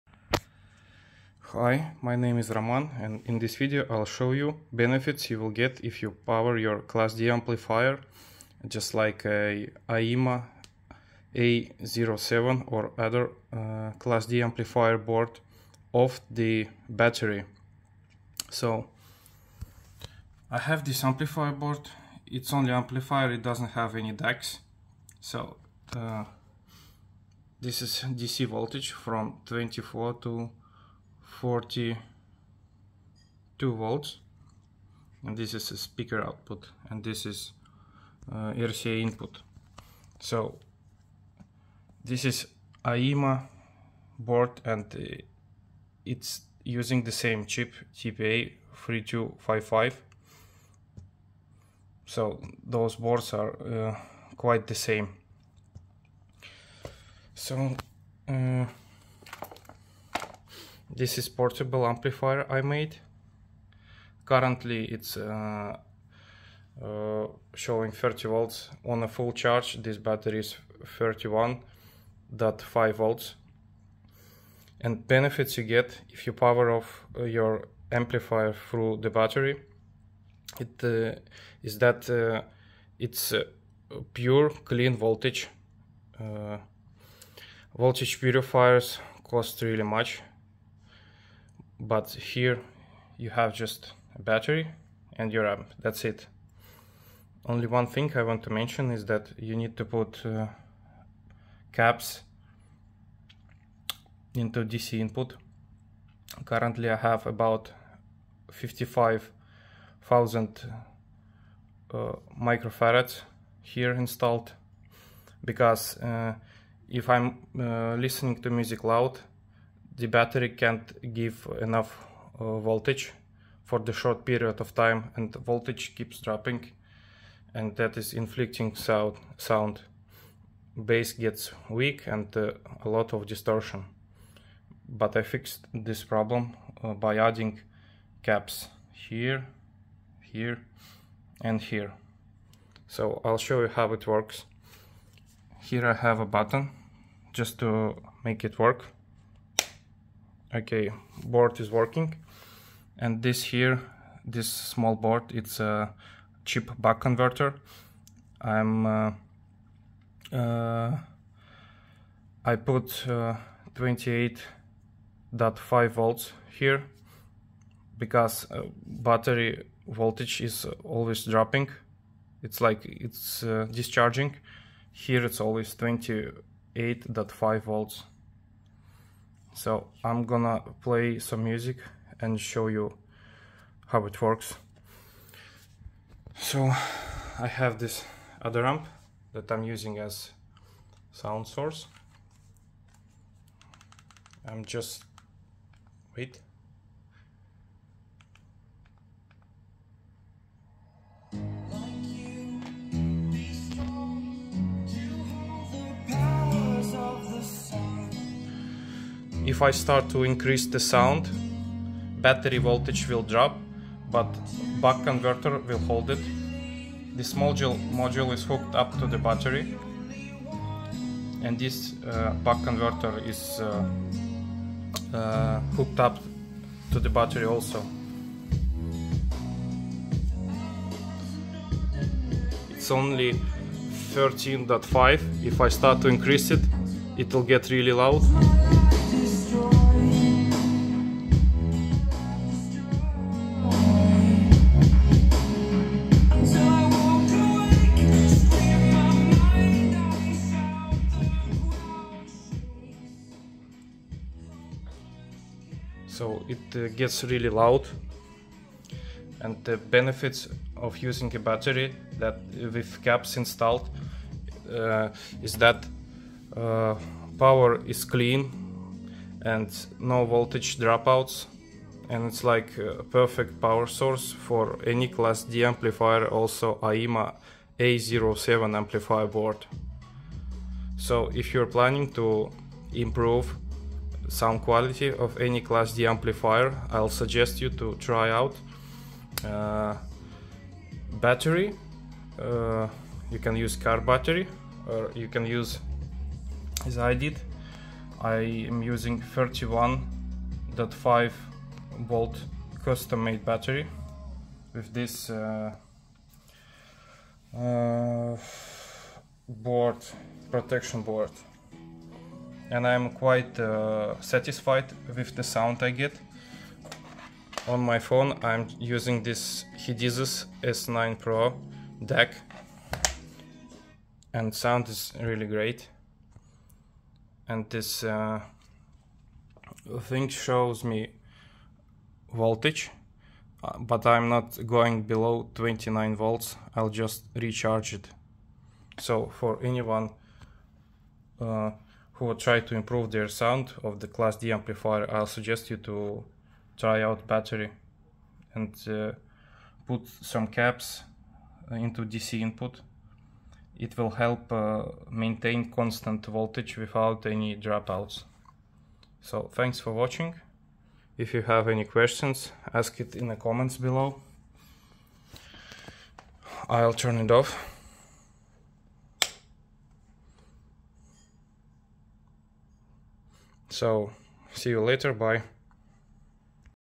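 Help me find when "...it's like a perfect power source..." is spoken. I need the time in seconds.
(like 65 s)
272 s.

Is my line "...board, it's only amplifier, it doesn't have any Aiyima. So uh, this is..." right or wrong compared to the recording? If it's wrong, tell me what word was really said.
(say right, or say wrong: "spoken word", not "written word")
wrong: "DACs", not "Aiyima".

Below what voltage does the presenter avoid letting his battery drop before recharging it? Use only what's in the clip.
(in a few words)
29 volts.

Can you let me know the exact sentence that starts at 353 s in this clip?
It will help uh, maintain constant voltage without any dropouts.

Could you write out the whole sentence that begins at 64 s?
Currently it's uh, uh, showing 30 volts on a full charge.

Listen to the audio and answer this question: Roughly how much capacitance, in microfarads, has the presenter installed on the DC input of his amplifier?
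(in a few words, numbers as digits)
55,000.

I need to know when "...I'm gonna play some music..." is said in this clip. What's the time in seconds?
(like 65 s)
180 s.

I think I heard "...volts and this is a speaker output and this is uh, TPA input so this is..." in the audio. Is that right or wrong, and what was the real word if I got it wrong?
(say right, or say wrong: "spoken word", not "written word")
wrong: "RCA", not "TPA".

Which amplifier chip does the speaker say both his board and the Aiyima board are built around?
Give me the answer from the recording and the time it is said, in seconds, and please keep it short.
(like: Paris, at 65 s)
TPA 3255, at 47 s.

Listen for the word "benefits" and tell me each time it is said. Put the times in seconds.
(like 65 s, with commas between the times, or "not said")
4 s, 75 s, 259 s.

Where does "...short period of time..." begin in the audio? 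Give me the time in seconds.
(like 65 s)
123 s.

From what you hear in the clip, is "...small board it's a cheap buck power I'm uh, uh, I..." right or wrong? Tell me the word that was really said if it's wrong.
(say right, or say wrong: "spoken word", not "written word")
wrong: "converter", not "power".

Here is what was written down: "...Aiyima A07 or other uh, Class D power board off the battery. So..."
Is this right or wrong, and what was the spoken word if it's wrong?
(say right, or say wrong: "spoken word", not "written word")
wrong: "amplifier", not "power".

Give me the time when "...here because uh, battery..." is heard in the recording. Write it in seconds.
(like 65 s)
166 s.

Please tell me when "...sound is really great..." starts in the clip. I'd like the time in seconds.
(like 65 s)
324 s.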